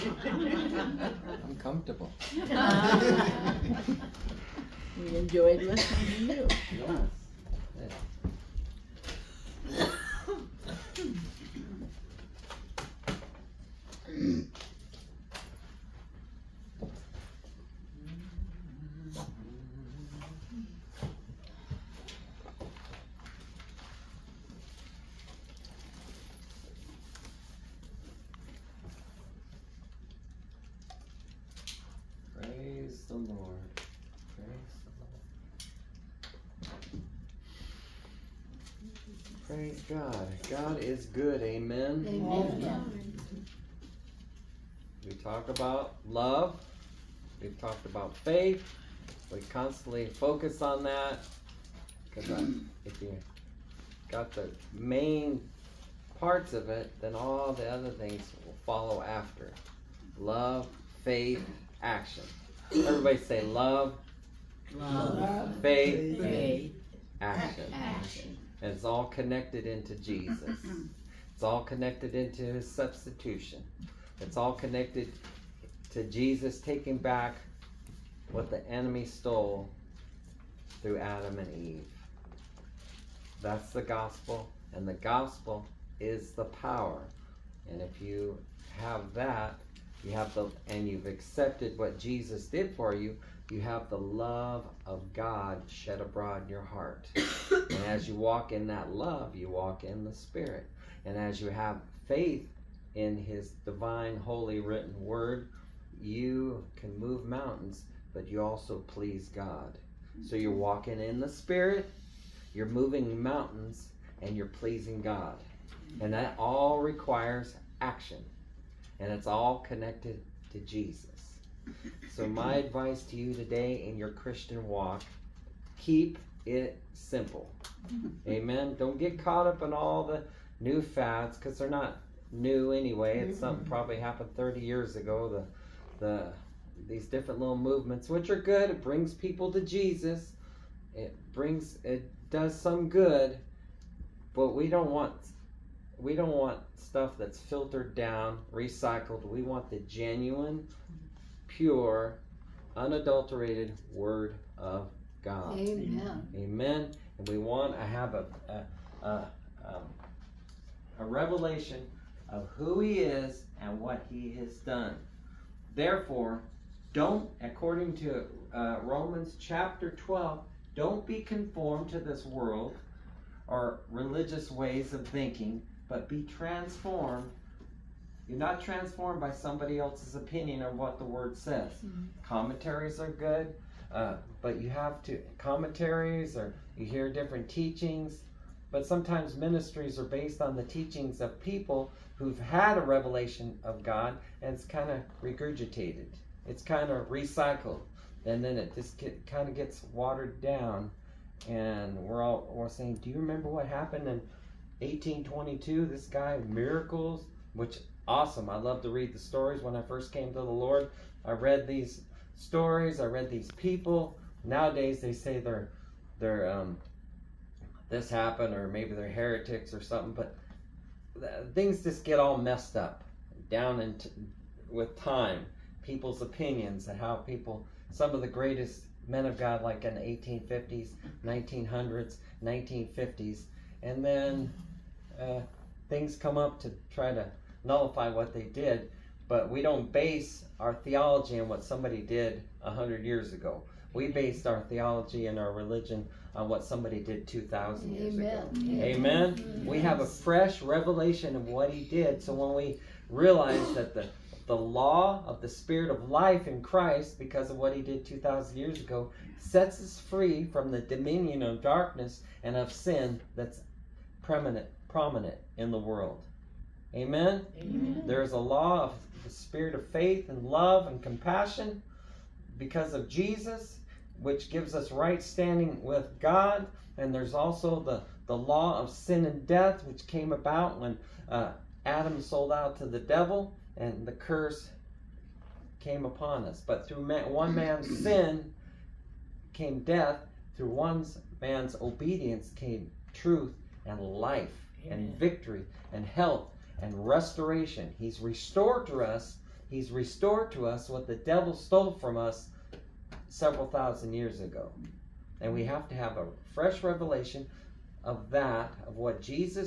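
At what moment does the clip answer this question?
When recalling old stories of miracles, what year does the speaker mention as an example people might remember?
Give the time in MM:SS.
03:24.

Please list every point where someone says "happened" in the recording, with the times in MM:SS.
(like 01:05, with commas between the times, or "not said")
02:13, 03:23, 03:38.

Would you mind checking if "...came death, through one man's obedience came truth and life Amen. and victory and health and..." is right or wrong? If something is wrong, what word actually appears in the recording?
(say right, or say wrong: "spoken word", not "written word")
right.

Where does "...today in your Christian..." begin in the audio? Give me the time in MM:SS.
02:03.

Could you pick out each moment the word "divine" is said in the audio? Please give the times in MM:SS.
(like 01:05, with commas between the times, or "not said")
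01:43.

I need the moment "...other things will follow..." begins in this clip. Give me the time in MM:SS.
00:57.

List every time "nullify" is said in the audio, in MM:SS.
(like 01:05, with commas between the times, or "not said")
03:57.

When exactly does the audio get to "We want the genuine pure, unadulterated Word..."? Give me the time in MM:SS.
02:29.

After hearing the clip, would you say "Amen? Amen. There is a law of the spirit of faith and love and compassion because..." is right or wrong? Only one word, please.
right.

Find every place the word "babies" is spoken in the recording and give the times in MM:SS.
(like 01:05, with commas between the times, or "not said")
not said.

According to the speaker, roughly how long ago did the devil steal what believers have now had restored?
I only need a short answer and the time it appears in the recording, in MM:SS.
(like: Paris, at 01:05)
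Several thousand years ago, at 05:03.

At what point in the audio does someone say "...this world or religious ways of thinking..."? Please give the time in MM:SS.
02:51.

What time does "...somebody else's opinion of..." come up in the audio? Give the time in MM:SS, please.
02:59.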